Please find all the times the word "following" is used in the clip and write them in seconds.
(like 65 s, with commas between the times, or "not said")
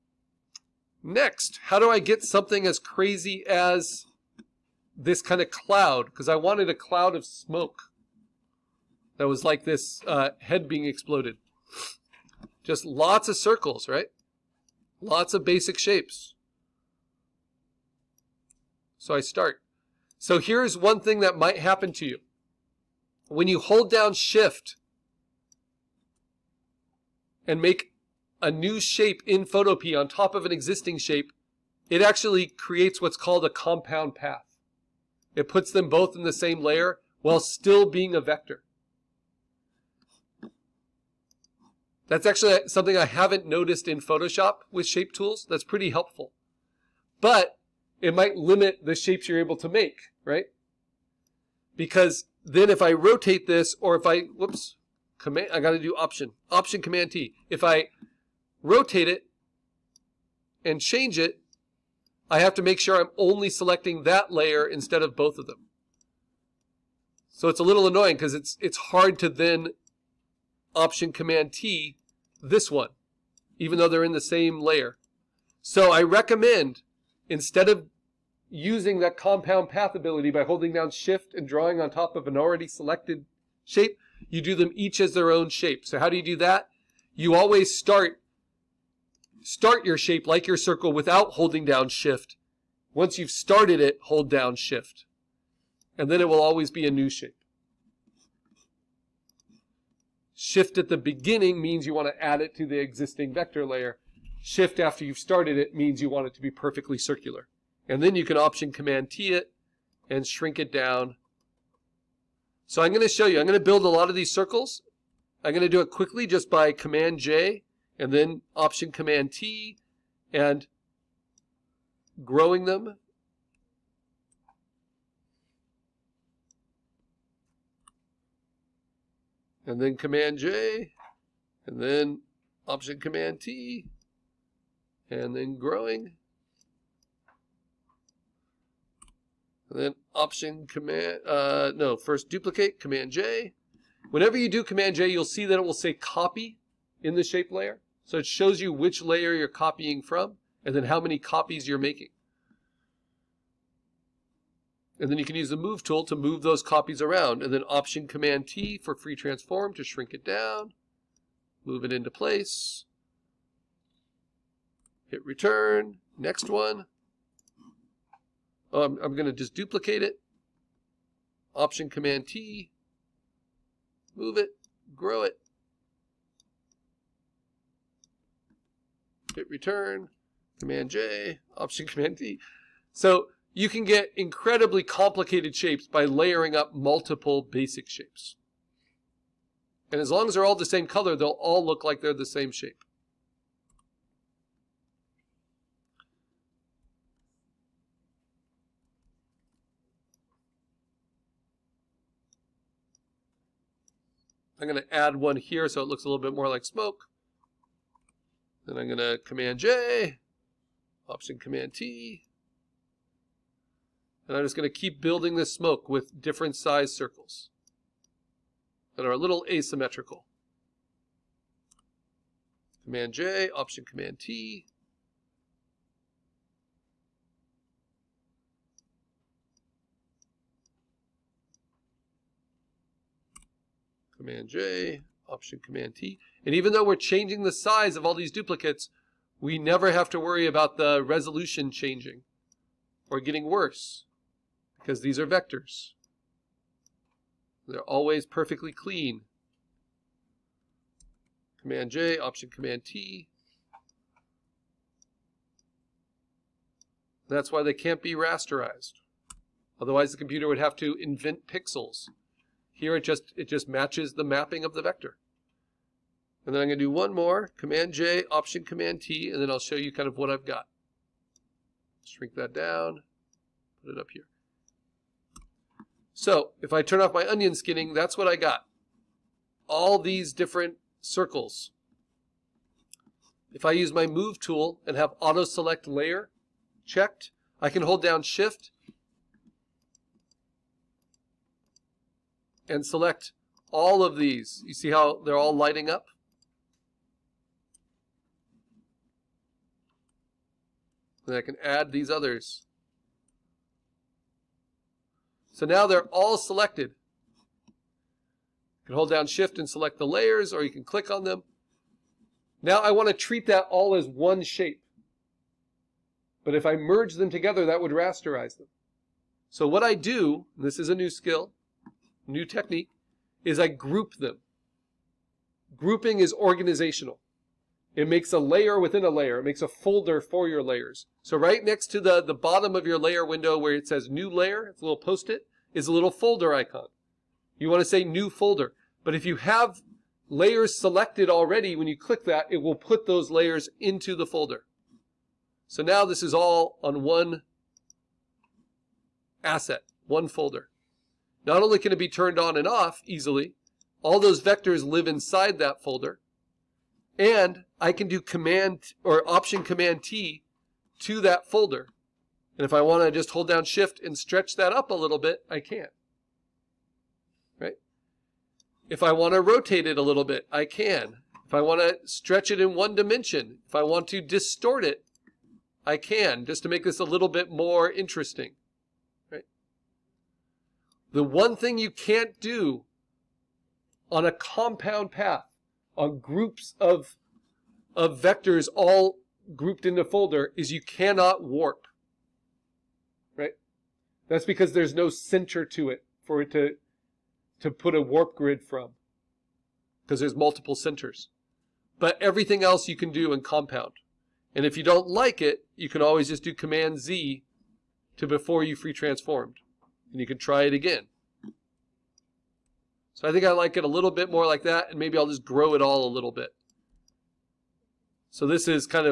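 not said.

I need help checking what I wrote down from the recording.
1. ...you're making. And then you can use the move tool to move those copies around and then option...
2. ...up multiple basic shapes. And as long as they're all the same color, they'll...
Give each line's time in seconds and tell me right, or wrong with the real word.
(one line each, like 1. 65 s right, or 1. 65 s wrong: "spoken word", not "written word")
1. 151 s right
2. 186 s right.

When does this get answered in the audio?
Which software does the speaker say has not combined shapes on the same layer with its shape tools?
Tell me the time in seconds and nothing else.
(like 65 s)
44 s.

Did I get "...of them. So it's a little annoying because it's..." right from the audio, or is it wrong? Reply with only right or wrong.
right.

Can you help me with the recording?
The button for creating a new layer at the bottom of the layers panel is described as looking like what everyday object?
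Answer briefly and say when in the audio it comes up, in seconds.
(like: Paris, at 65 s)
post-it, at 334 s.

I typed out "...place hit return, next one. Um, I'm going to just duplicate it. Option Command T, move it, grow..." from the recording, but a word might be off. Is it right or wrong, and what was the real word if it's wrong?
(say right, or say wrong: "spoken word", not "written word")
right.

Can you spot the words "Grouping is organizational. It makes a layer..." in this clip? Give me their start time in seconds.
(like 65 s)
325 s.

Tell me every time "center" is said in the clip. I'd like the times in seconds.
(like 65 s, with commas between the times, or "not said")
395 s, 400 s.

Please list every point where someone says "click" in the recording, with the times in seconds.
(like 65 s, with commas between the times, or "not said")
310 s, 341 s.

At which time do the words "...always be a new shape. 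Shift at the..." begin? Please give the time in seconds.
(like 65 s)
96 s.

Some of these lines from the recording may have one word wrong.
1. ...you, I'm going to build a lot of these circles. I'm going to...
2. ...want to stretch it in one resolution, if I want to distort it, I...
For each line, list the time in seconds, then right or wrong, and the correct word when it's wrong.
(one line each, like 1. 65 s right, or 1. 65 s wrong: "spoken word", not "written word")
1. 113 s right
2. 371 s wrong: "dimension", not "resolution".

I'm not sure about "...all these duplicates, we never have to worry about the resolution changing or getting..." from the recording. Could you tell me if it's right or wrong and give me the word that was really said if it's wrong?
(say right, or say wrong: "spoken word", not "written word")
right.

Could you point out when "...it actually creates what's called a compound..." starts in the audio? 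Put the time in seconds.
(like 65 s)
31 s.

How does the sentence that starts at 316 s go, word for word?
But if I merge them together, that would rasterize them.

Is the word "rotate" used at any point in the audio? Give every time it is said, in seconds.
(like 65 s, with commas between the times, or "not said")
52 s, 58 s, 369 s.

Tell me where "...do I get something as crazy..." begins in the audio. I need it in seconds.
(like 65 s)
1 s.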